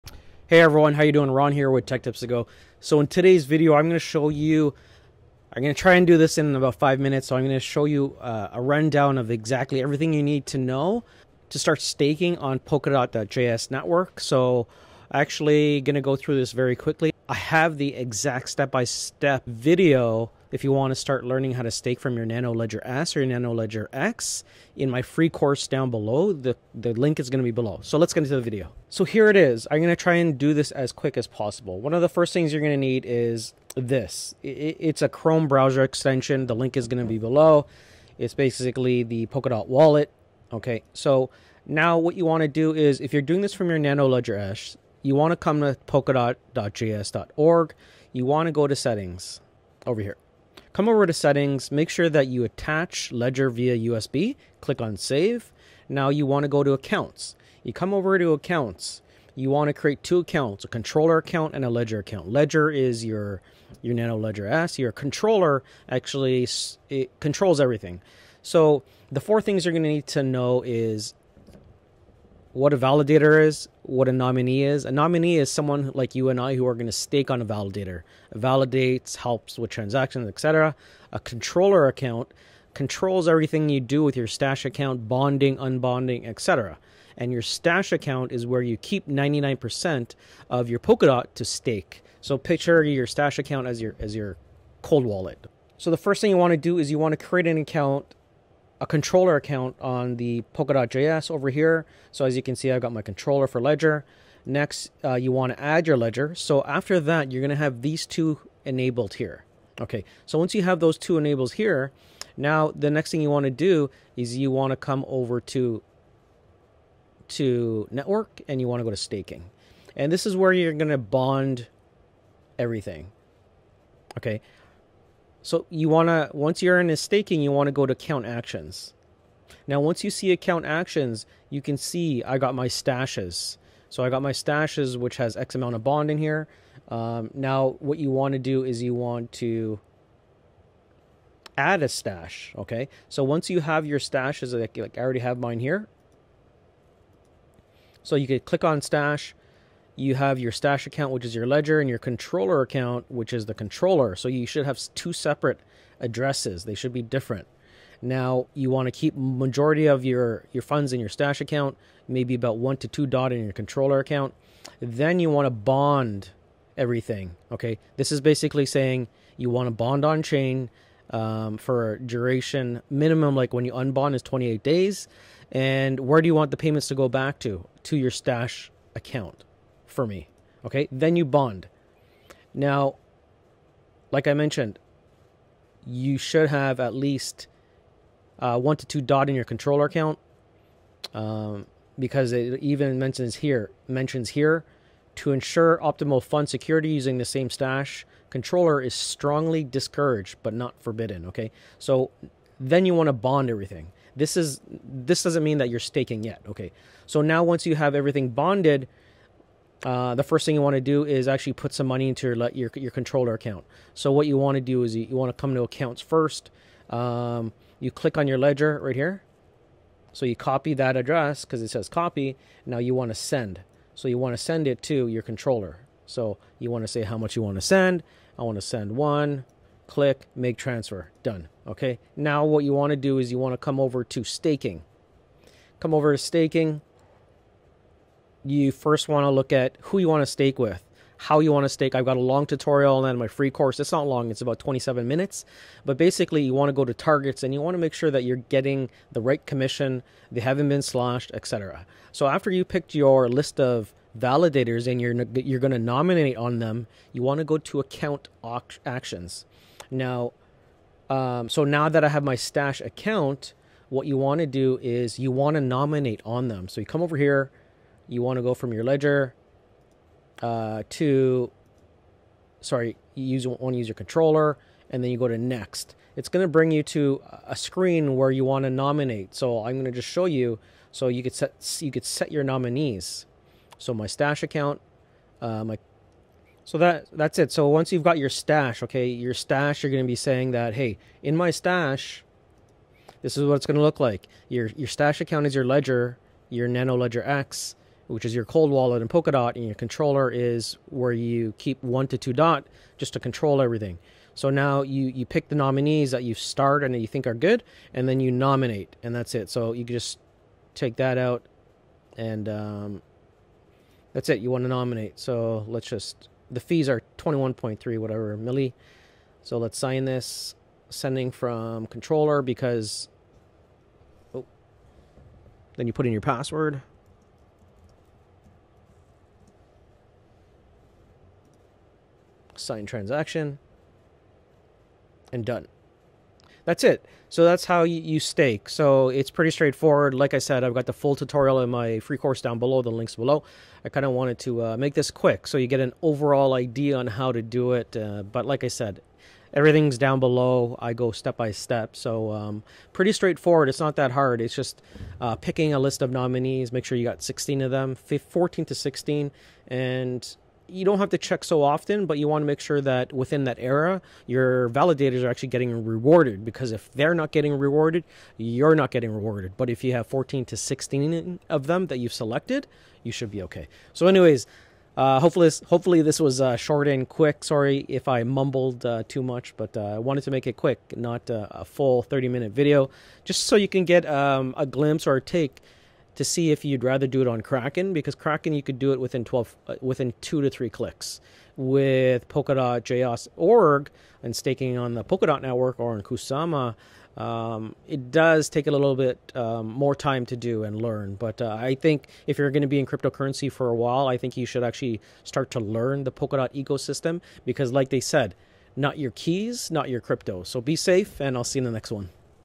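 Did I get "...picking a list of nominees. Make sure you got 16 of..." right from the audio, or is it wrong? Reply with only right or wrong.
right.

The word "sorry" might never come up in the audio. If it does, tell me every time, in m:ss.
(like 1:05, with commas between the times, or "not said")
4:32, 6:17.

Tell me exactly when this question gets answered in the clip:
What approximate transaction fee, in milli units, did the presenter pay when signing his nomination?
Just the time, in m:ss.
5:17.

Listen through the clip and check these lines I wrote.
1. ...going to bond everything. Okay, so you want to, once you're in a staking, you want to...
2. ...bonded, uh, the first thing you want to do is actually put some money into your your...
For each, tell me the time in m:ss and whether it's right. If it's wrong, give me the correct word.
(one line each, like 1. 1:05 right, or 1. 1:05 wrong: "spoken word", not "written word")
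1. 2:00 right
2. 3:28 right.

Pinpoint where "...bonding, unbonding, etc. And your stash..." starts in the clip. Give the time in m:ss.
1:25.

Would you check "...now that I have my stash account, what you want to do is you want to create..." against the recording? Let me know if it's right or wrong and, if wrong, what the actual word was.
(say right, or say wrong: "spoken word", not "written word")
wrong: "nominate", not "create".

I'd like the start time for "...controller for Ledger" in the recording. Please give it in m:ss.
1:43.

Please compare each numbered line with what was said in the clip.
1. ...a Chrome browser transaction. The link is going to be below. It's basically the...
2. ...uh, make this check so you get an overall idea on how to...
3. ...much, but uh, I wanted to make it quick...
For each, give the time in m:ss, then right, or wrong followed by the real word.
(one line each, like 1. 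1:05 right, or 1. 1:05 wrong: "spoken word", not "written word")
1. 0:35 wrong: "extension", not "transaction"
2. 5:44 wrong: "quick", not "check"
3. 6:19 right.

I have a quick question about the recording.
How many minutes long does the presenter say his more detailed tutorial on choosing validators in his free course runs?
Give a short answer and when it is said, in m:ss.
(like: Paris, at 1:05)
27 minutes, at 4:04.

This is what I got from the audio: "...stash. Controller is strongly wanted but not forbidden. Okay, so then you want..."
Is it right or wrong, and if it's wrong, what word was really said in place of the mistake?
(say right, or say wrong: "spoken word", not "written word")
wrong: "discouraged", not "wanted".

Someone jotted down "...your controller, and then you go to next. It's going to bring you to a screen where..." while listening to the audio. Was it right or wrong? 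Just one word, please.
right.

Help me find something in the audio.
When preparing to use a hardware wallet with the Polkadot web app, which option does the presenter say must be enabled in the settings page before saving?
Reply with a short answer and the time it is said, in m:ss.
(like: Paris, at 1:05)
Attach Ledger via USB, at 0:52.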